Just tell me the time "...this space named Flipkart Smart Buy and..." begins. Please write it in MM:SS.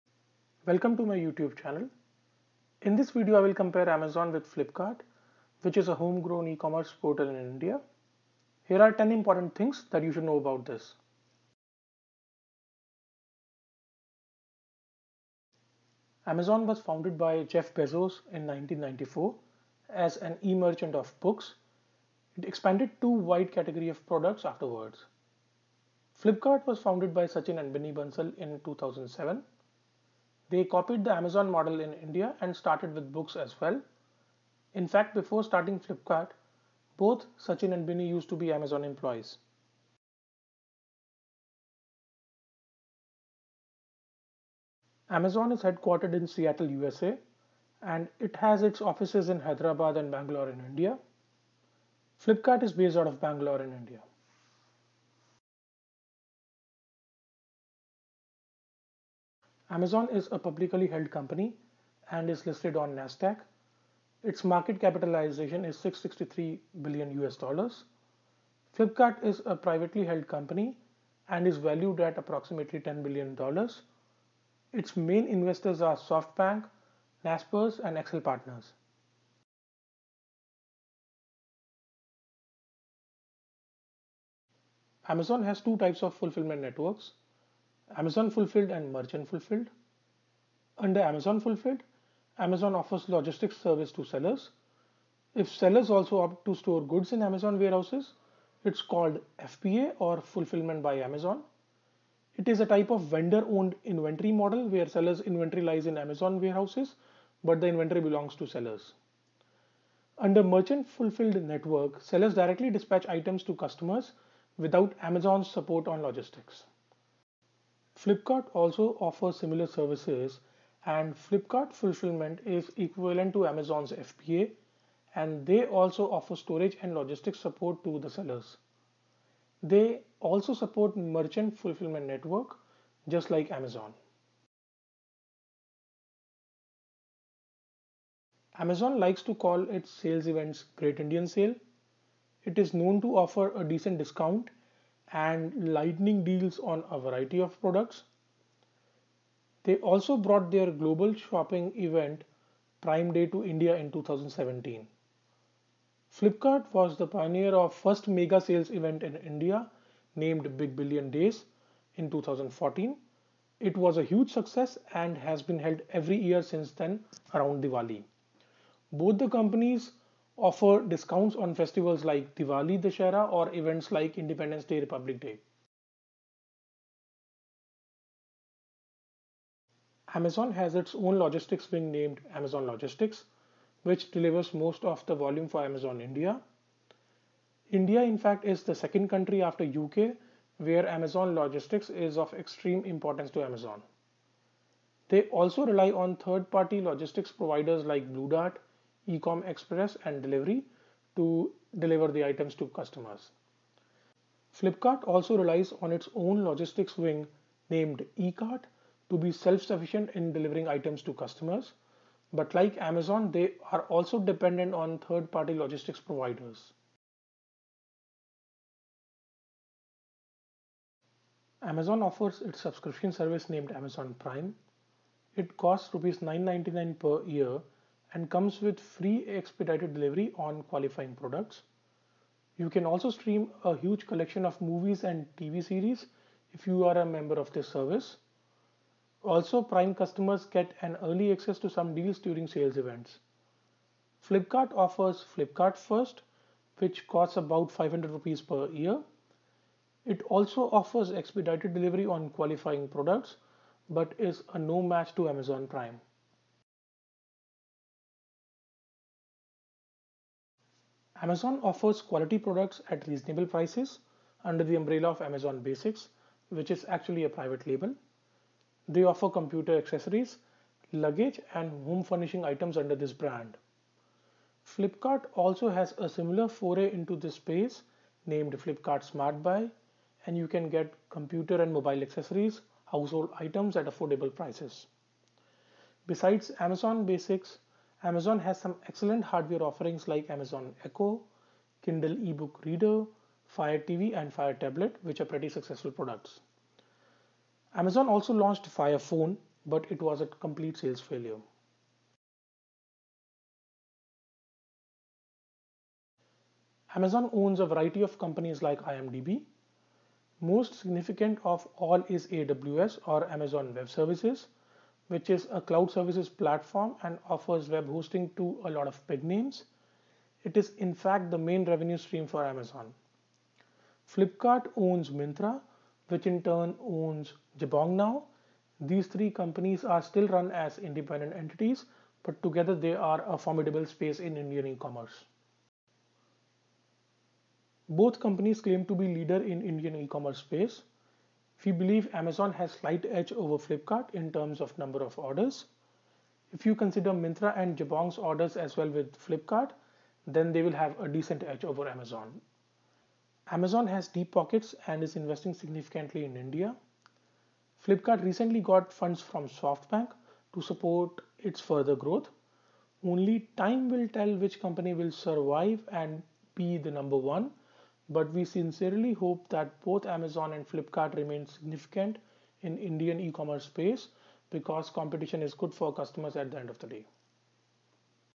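04:37.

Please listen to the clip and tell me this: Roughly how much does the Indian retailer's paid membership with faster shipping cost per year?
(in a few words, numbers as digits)
500 rupees.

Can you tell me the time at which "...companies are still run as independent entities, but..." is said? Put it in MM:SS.
05:29.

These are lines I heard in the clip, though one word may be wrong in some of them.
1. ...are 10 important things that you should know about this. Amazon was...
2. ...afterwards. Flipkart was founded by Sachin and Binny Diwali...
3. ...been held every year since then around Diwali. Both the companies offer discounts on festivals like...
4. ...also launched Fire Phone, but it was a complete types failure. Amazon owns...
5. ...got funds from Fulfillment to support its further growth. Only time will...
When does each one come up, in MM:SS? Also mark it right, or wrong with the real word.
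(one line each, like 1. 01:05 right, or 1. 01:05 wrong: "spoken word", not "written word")
1. 00:08 right
2. 00:24 wrong: "Bansal", not "Diwali"
3. 02:45 right
4. 04:58 wrong: "sales", not "types"
5. 05:58 wrong: "SoftBank", not "Fulfillment".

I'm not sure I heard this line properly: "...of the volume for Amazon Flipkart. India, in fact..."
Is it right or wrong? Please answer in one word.
wrong.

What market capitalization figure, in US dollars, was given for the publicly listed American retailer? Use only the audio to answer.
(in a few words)
663 billion.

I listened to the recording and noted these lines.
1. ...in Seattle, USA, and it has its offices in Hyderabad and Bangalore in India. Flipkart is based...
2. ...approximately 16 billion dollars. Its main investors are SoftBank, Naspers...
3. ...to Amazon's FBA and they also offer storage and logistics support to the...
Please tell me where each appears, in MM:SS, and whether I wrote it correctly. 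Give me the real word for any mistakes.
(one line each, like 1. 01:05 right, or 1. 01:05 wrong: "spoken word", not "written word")
1. 00:46 right
2. 01:12 wrong: "10", not "16"
3. 02:03 right.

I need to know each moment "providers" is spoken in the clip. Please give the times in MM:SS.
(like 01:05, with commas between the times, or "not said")
03:17, 03:35.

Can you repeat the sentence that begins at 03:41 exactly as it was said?
Amazon offers its subscription service named Amazon Prime.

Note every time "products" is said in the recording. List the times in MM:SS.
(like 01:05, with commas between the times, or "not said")
00:24, 02:27, 03:51, 04:12, 04:22, 04:55.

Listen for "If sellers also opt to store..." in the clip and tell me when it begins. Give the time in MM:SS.
01:35.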